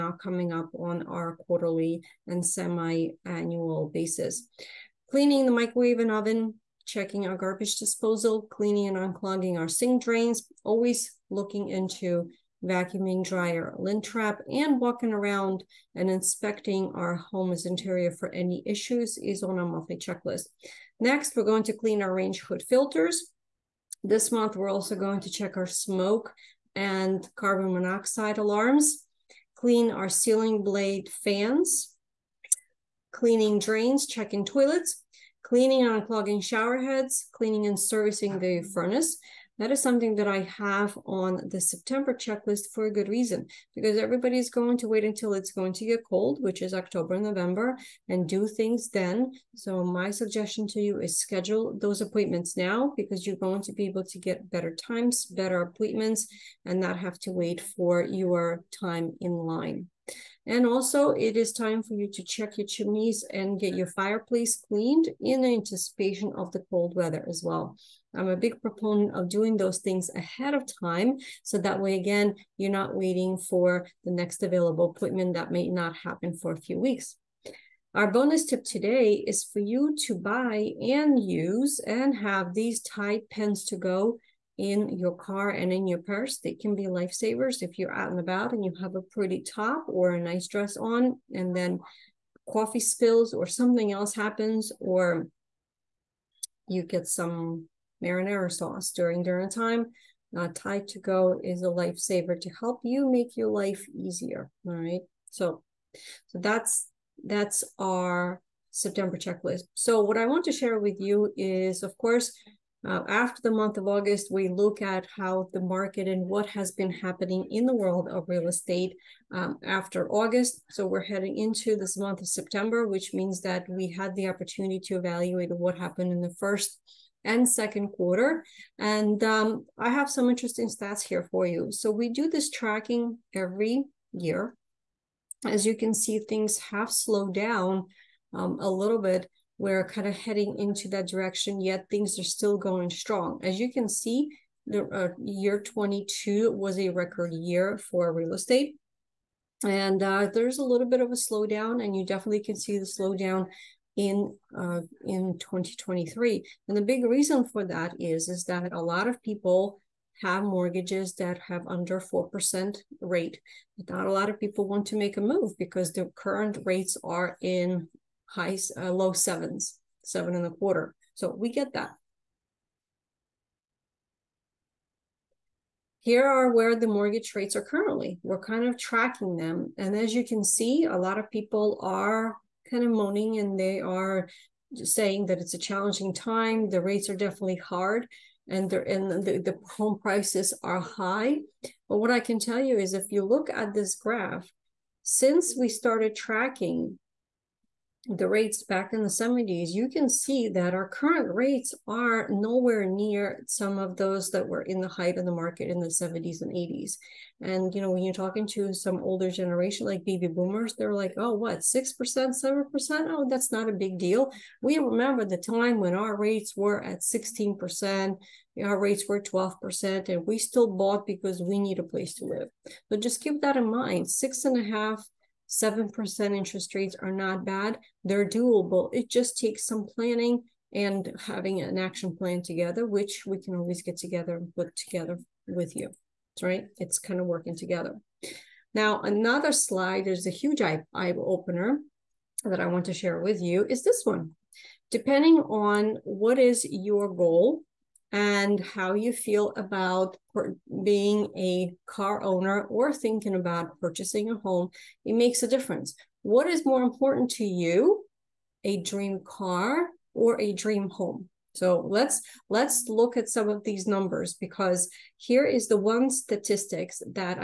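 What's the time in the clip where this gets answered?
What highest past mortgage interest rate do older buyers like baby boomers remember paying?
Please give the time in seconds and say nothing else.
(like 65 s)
217 s.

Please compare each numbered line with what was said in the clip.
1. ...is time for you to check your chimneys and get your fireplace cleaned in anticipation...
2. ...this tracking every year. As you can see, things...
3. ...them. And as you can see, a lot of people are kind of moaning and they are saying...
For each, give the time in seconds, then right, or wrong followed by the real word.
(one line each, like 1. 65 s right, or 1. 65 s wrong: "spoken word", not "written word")
1. 61 s right
2. 132 s right
3. 179 s right.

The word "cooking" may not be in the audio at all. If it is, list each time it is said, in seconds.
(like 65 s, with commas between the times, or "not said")
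not said.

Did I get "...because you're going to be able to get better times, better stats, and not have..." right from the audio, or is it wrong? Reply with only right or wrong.
wrong.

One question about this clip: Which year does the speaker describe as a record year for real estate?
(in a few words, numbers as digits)
2022.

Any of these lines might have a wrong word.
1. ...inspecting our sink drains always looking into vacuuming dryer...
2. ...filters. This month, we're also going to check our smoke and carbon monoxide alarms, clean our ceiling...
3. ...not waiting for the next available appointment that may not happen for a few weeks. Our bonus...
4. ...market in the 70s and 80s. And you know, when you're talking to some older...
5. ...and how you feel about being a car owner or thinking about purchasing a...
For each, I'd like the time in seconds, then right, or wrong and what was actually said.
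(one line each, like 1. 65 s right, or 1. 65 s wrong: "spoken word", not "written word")
1. 8 s wrong: "unclogging", not "inspecting"
2. 22 s right
3. 72 s right
4. 205 s right
5. 248 s right.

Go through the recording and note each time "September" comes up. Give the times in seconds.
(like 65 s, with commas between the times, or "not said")
41 s, 108 s, 122 s.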